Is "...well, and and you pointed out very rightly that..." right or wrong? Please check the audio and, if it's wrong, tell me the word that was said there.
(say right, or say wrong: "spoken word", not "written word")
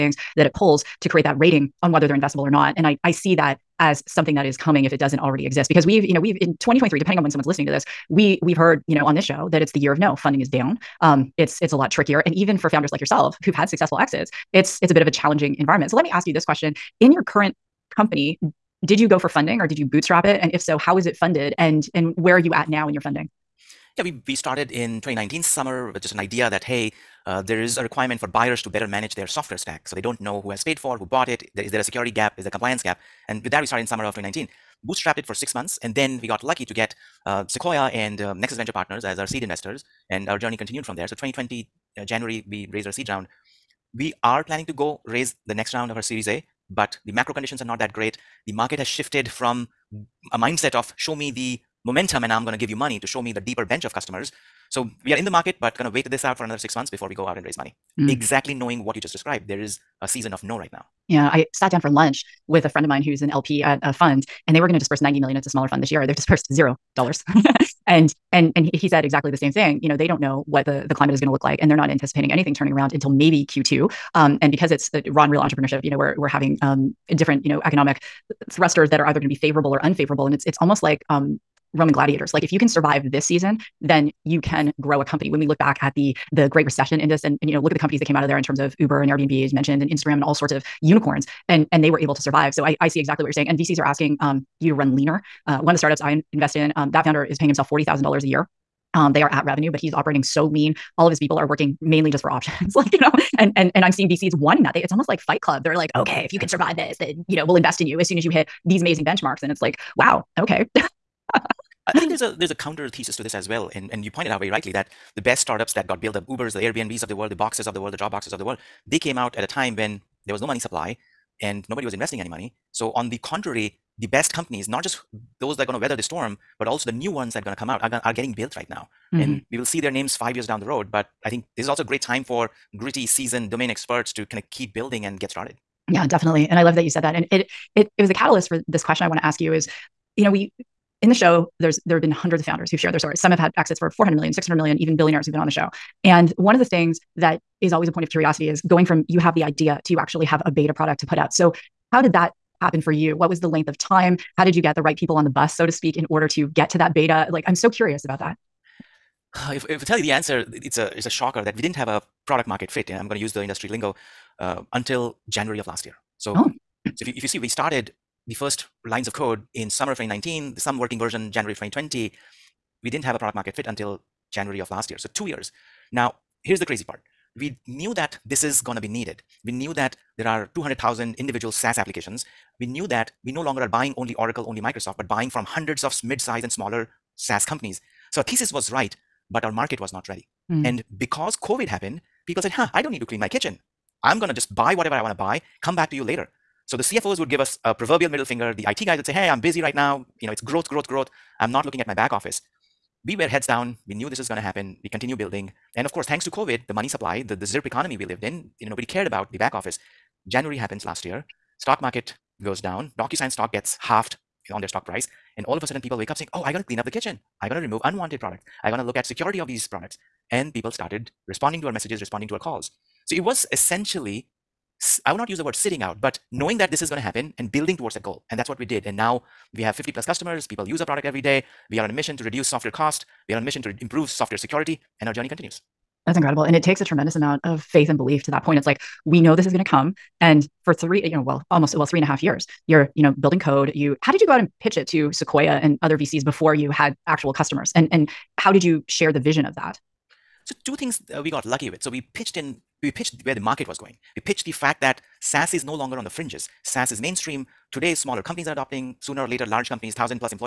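right.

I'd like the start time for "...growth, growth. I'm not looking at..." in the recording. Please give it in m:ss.
3:20.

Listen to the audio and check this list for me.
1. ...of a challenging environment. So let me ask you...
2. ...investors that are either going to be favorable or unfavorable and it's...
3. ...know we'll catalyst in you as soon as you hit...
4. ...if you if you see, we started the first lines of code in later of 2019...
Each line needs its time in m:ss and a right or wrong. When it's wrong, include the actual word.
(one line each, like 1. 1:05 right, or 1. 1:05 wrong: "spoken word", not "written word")
1. 0:15 right
2. 1:18 wrong: "thrusters", not "investors"
3. 1:47 wrong: "invest", not "catalyst"
4. 2:47 wrong: "summer", not "later".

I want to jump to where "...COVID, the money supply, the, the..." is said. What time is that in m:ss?
3:26.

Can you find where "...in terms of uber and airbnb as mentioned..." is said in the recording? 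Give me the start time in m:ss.
1:28.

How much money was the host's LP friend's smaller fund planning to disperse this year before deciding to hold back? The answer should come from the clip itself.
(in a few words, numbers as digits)
90 million.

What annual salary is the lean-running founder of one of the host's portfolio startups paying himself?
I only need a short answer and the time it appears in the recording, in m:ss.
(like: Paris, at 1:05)
$40,000, at 1:37.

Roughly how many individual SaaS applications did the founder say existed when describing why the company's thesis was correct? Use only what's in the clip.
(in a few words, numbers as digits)
200,000.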